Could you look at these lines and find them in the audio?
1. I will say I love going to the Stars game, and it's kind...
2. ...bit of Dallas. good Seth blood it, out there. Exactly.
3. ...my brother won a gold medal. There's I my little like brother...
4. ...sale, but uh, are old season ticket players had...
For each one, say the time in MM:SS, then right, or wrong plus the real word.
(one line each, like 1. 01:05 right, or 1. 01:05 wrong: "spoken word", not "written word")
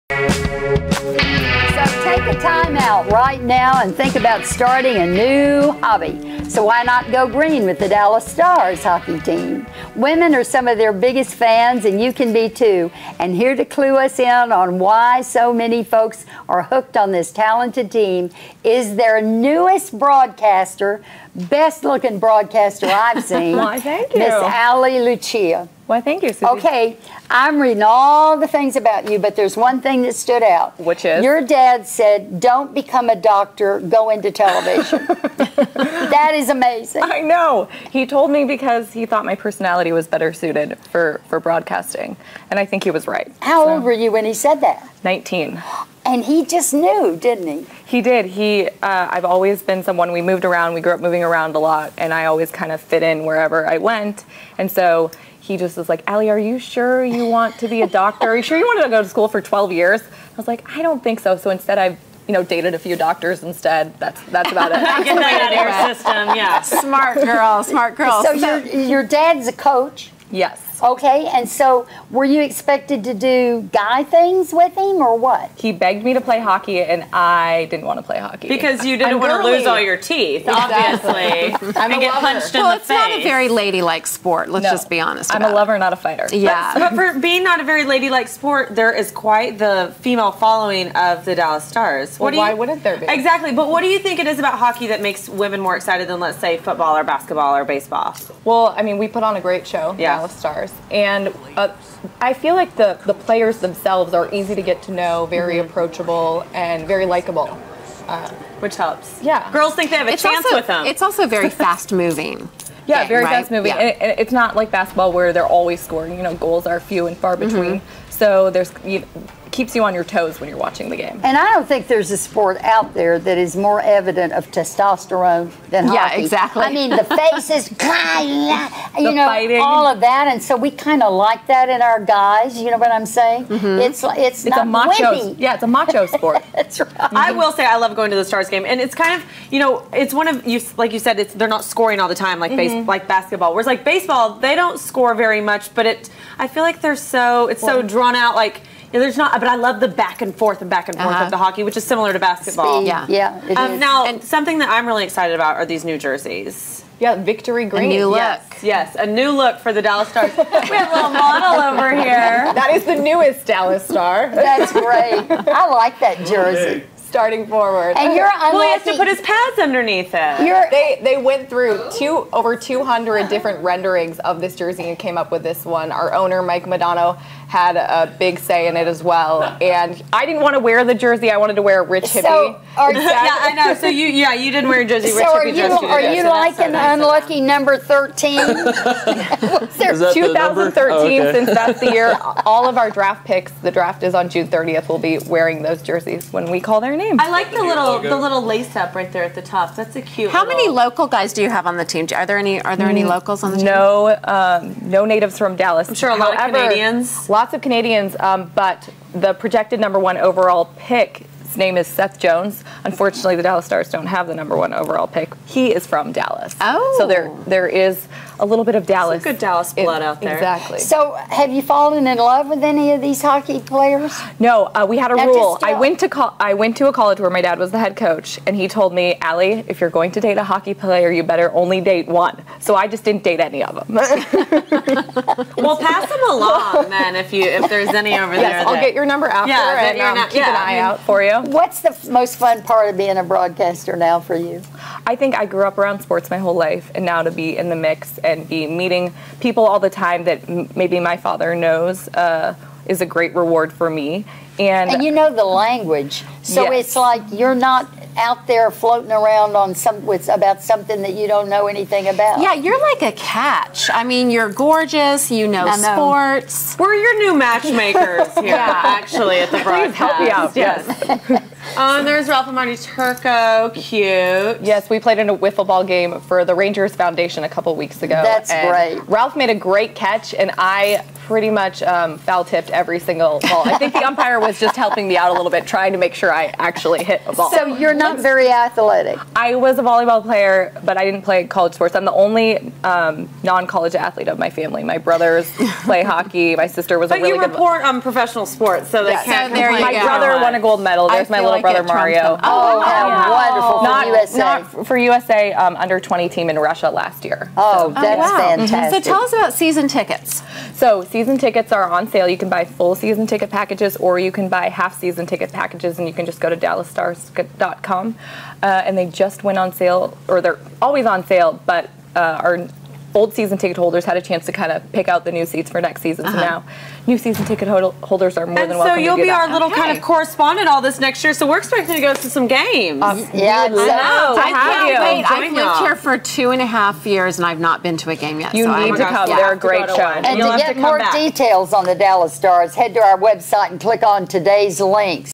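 1. 02:17 right
2. 03:38 wrong: "Dallas", not "Seth"
3. 04:59 right
4. 05:21 wrong: "holders", not "players".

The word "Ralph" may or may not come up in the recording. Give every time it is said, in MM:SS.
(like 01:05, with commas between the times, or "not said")
04:32, 04:39.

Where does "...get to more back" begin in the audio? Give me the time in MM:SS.
05:40.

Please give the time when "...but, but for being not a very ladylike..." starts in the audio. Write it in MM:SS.
01:26.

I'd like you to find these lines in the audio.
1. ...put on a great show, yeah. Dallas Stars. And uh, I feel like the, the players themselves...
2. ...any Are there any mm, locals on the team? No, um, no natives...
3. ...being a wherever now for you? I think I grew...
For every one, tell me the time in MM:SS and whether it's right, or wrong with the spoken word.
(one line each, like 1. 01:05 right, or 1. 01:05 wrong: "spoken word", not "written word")
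1. 01:39 right
2. 03:22 right
3. 04:02 wrong: "broadcaster", not "wherever".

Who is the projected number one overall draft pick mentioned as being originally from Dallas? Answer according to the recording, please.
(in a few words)
Seth Jones.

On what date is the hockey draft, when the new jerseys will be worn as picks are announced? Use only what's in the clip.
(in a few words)
June 30th.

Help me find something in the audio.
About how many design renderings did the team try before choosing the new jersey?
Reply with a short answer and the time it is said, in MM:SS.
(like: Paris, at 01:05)
over 200, at 02:52.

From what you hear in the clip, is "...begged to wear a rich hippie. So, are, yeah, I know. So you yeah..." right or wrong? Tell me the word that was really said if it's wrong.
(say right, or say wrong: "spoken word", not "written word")
wrong: "wanted", not "begged".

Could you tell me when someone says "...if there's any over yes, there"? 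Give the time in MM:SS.
03:57.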